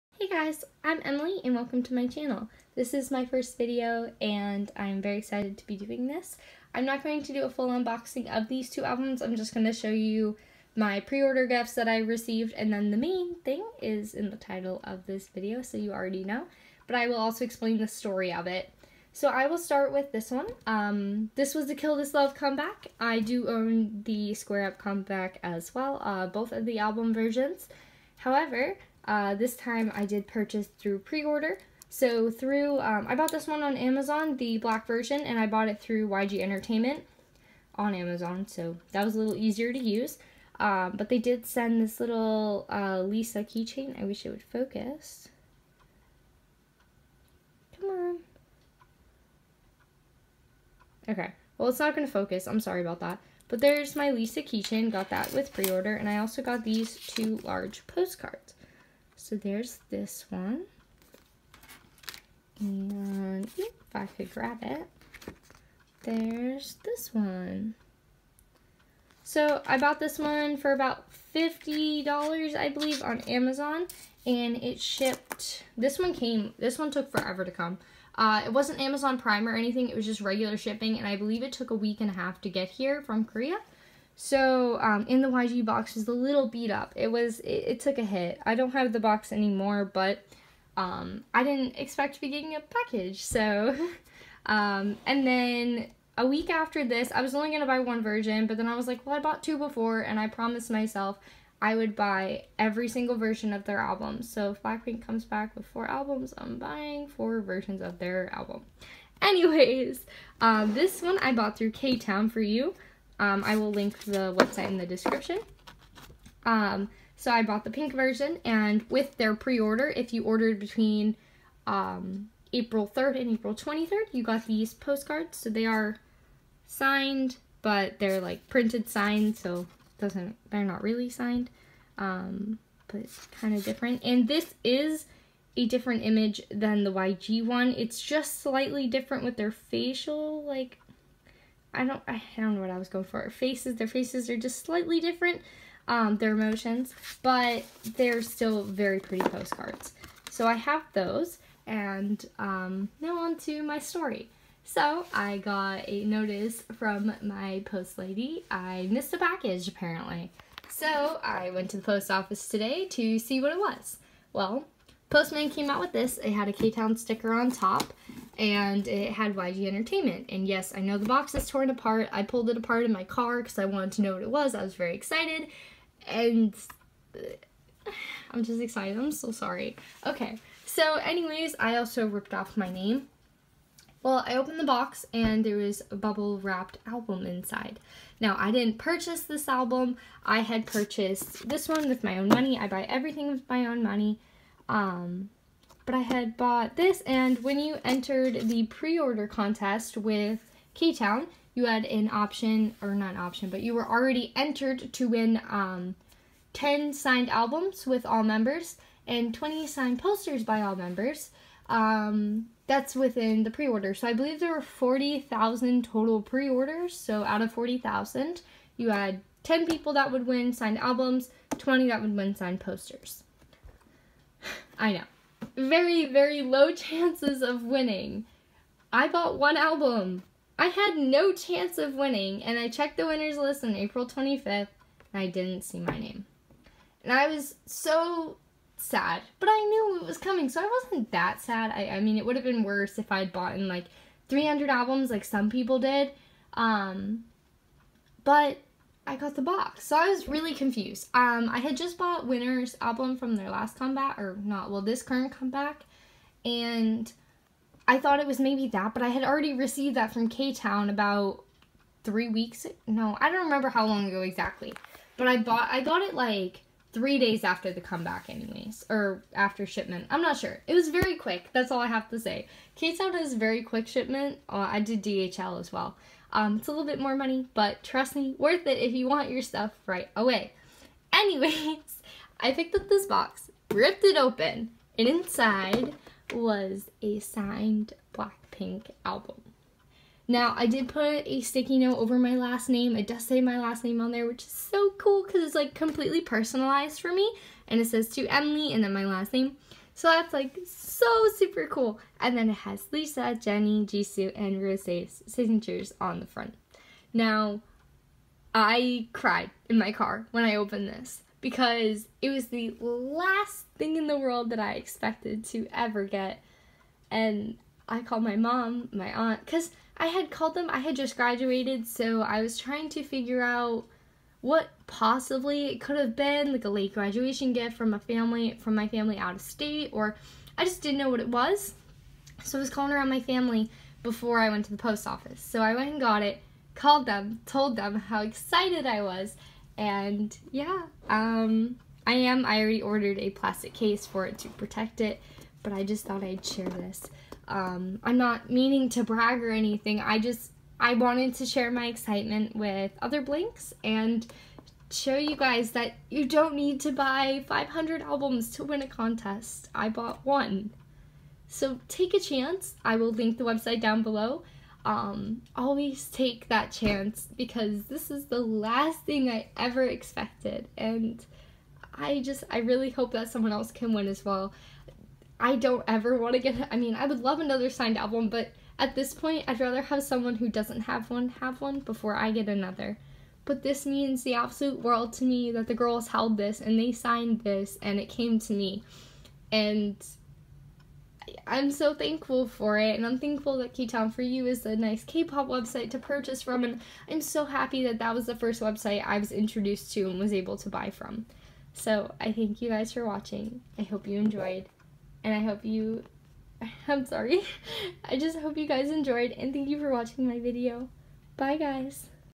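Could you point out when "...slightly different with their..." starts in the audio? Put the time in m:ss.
2:18.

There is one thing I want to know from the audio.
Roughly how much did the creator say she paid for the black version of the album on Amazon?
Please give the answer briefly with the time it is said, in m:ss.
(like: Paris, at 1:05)
$50, at 1:10.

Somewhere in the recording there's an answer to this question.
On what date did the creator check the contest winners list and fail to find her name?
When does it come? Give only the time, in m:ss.
3:53.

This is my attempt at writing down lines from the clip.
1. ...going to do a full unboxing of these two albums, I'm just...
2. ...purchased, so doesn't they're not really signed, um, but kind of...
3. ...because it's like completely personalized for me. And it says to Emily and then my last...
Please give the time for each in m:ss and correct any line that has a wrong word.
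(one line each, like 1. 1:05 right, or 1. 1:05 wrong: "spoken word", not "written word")
1. 0:07 right
2. 2:08 wrong: "signed", not "purchased"
3. 4:55 right.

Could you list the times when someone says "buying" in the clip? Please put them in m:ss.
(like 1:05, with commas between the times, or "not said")
1:46.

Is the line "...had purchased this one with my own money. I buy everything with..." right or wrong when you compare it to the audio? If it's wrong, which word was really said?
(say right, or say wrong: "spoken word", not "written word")
right.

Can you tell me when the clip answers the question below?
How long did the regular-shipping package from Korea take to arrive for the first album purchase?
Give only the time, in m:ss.
1:21.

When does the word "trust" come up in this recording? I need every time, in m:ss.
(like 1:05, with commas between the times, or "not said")
4:37.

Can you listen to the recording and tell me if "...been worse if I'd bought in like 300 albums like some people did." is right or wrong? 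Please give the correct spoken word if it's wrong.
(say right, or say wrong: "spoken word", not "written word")
right.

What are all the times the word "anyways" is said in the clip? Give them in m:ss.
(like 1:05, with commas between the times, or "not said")
1:49, 3:00, 4:28, 4:41.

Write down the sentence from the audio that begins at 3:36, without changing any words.
So out of 40,000, you had 10 people that would win signed albums, 20 that would win signed posters.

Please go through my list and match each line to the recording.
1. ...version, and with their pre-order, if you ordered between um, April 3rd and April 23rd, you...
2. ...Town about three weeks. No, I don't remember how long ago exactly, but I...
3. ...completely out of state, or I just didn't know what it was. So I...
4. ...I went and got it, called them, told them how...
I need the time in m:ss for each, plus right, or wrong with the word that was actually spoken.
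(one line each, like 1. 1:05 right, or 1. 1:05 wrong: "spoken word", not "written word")
1. 1:57 right
2. 4:20 right
3. 5:28 wrong: "family", not "completely"
4. 5:35 right.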